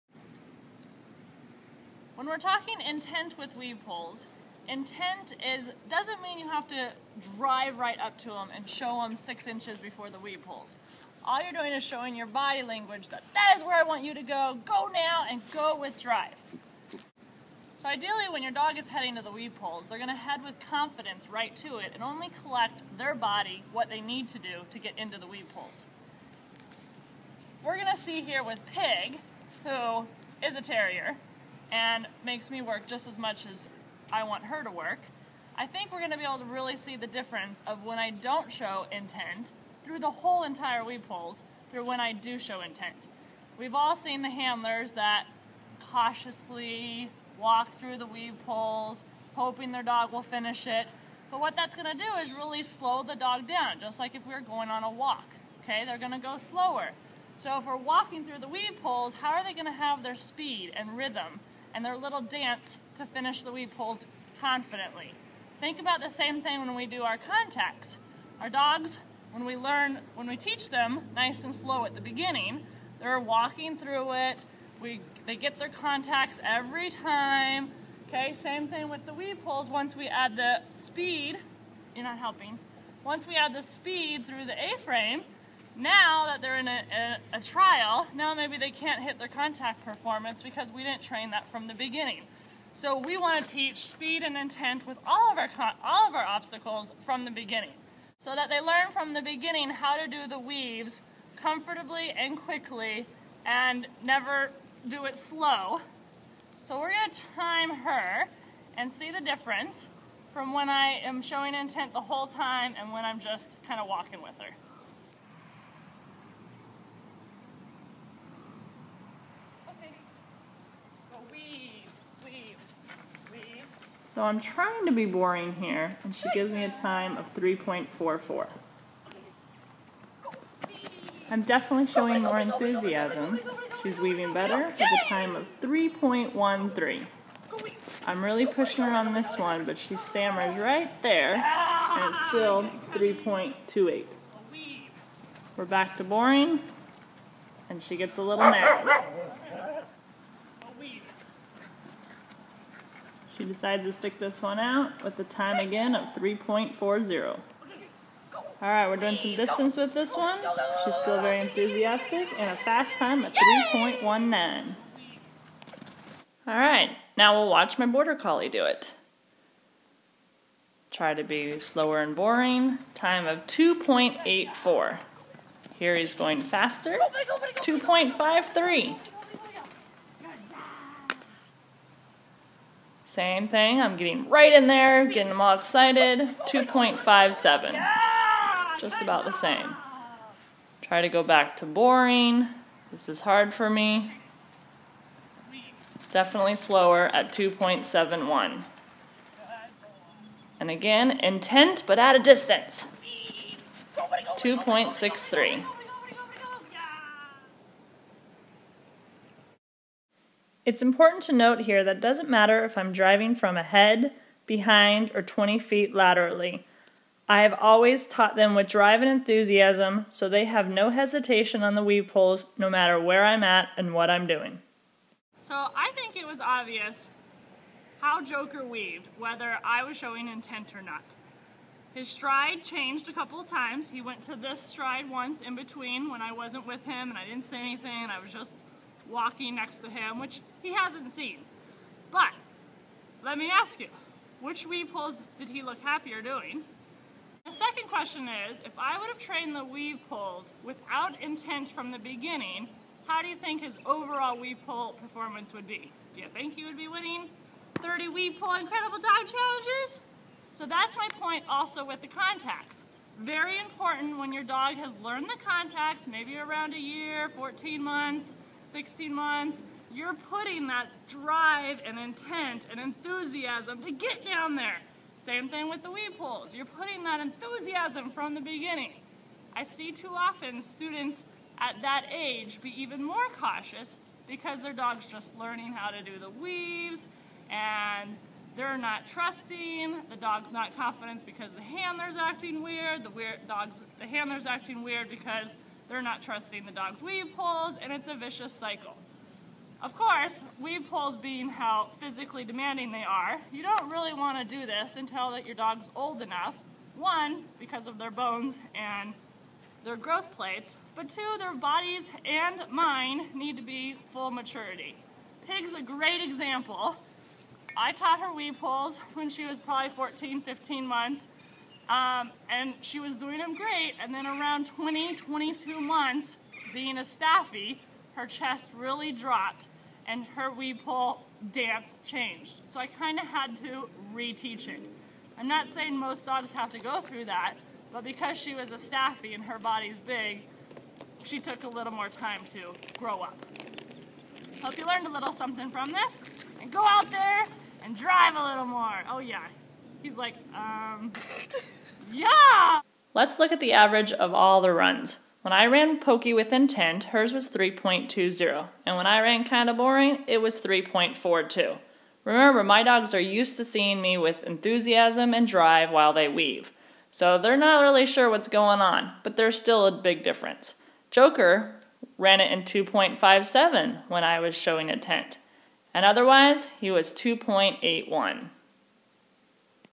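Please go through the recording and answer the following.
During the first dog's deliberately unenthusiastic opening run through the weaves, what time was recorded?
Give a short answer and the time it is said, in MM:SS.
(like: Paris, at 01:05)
3.44, at 02:07.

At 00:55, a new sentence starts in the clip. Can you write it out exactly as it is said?
Okay, they're going to go slower.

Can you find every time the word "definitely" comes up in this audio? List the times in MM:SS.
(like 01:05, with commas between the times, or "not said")
02:11, 03:16.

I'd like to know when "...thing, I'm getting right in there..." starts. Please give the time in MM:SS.
03:03.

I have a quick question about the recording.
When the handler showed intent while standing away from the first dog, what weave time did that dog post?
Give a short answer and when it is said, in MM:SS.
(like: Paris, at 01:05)
3.19, at 02:43.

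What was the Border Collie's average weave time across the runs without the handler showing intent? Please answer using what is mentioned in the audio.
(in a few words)
2.81.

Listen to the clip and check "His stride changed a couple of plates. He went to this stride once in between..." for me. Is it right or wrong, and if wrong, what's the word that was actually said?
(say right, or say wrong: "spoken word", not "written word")
wrong: "times", not "plates".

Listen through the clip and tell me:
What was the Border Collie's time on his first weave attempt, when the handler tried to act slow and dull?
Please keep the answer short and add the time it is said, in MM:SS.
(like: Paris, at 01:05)
2.84, at 02:53.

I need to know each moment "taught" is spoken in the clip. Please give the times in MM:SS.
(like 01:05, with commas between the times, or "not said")
03:38, 05:17.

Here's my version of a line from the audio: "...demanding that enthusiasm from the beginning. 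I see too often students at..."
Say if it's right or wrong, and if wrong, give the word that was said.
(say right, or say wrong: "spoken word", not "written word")
wrong: "putting", not "demanding".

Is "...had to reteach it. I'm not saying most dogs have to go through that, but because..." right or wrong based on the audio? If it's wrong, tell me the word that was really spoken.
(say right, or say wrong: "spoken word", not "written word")
right.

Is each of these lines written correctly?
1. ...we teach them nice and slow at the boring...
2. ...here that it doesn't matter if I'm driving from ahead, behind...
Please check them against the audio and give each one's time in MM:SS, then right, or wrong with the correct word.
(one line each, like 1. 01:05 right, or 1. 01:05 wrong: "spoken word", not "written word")
1. 01:10 wrong: "beginning", not "boring"
2. 03:31 right.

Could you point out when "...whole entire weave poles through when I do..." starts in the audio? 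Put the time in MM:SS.
00:40.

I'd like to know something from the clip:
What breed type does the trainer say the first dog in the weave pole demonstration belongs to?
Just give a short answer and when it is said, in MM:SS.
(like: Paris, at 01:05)
terrier, at 00:30.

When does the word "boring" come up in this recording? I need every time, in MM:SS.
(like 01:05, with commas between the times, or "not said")
02:05, 02:26, 02:52, 03:11, 05:59.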